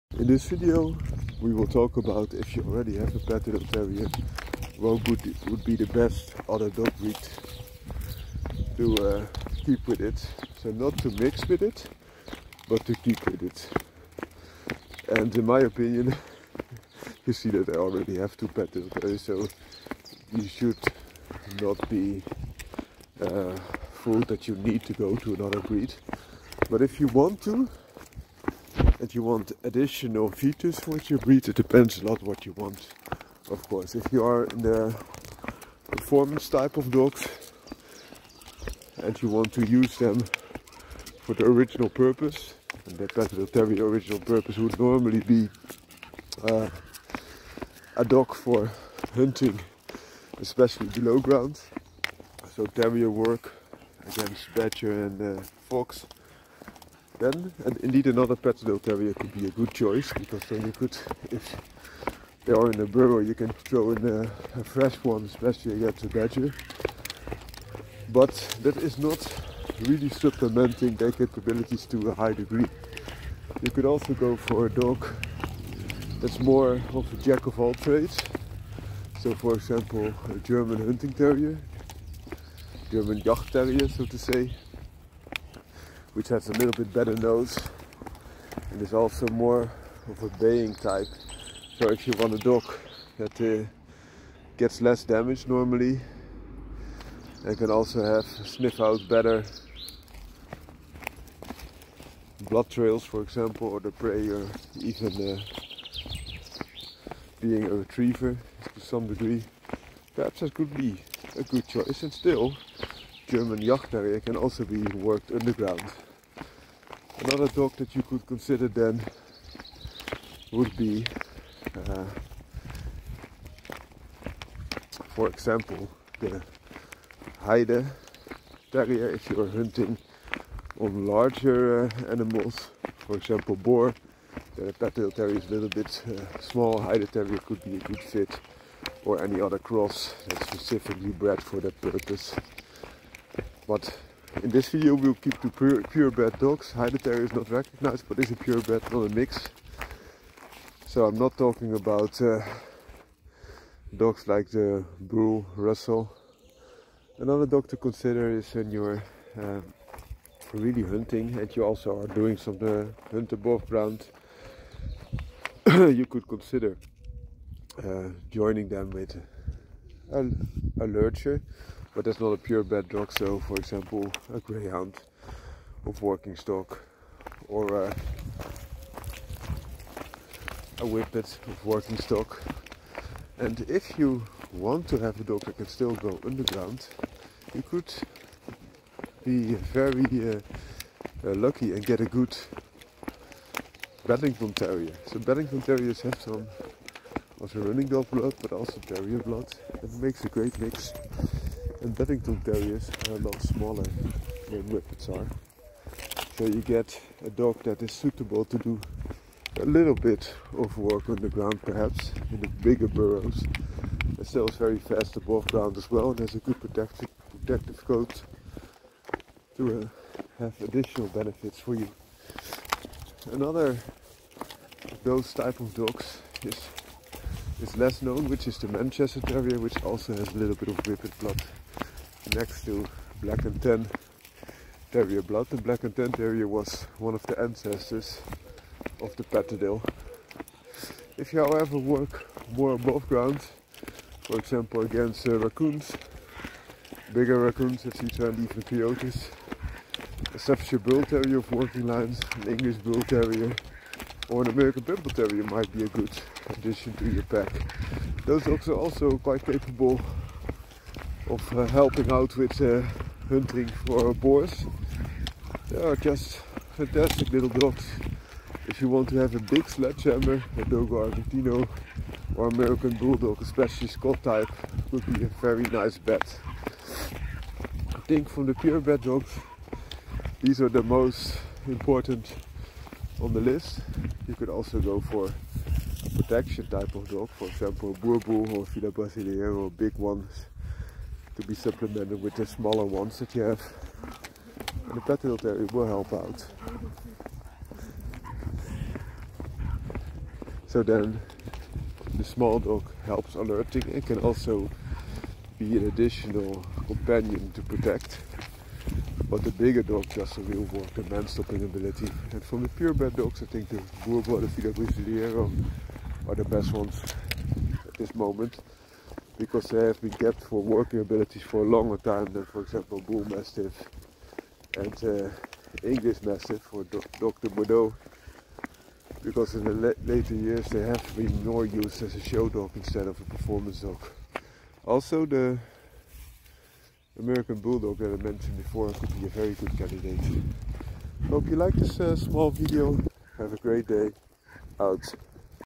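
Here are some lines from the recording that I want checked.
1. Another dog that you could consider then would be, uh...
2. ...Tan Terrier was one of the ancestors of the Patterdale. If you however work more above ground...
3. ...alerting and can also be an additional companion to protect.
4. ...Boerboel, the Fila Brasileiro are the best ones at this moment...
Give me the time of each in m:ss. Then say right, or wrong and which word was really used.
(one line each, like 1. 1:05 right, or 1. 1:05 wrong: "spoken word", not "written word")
1. 1:57 right
2. 3:55 right
3. 5:03 right
4. 5:14 right.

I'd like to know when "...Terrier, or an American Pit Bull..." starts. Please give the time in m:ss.
4:13.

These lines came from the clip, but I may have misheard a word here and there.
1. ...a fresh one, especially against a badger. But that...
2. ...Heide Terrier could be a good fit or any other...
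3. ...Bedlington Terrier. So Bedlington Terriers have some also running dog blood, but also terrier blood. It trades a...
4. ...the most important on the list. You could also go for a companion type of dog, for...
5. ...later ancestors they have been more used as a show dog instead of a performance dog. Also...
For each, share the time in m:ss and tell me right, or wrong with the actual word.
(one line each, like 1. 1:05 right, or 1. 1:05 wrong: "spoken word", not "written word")
1. 1:04 right
2. 2:16 right
3. 3:14 wrong: "makes", not "trades"
4. 4:40 wrong: "protection", not "companion"
5. 5:30 wrong: "years", not "ancestors".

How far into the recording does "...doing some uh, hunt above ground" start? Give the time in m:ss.
2:42.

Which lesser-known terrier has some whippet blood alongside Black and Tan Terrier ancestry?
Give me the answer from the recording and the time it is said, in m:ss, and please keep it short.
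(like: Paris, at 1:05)
Manchester Terrier, at 3:48.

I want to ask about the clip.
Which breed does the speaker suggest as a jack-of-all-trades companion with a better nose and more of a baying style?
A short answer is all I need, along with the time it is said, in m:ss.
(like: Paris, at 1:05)
German Jagdterrier, at 1:53.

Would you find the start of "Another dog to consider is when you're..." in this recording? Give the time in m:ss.
2:37.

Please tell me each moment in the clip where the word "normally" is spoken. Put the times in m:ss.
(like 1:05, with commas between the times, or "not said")
0:44, 1:35.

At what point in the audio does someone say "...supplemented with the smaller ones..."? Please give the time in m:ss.
4:51.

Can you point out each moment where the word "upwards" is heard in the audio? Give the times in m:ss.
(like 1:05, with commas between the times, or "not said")
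not said.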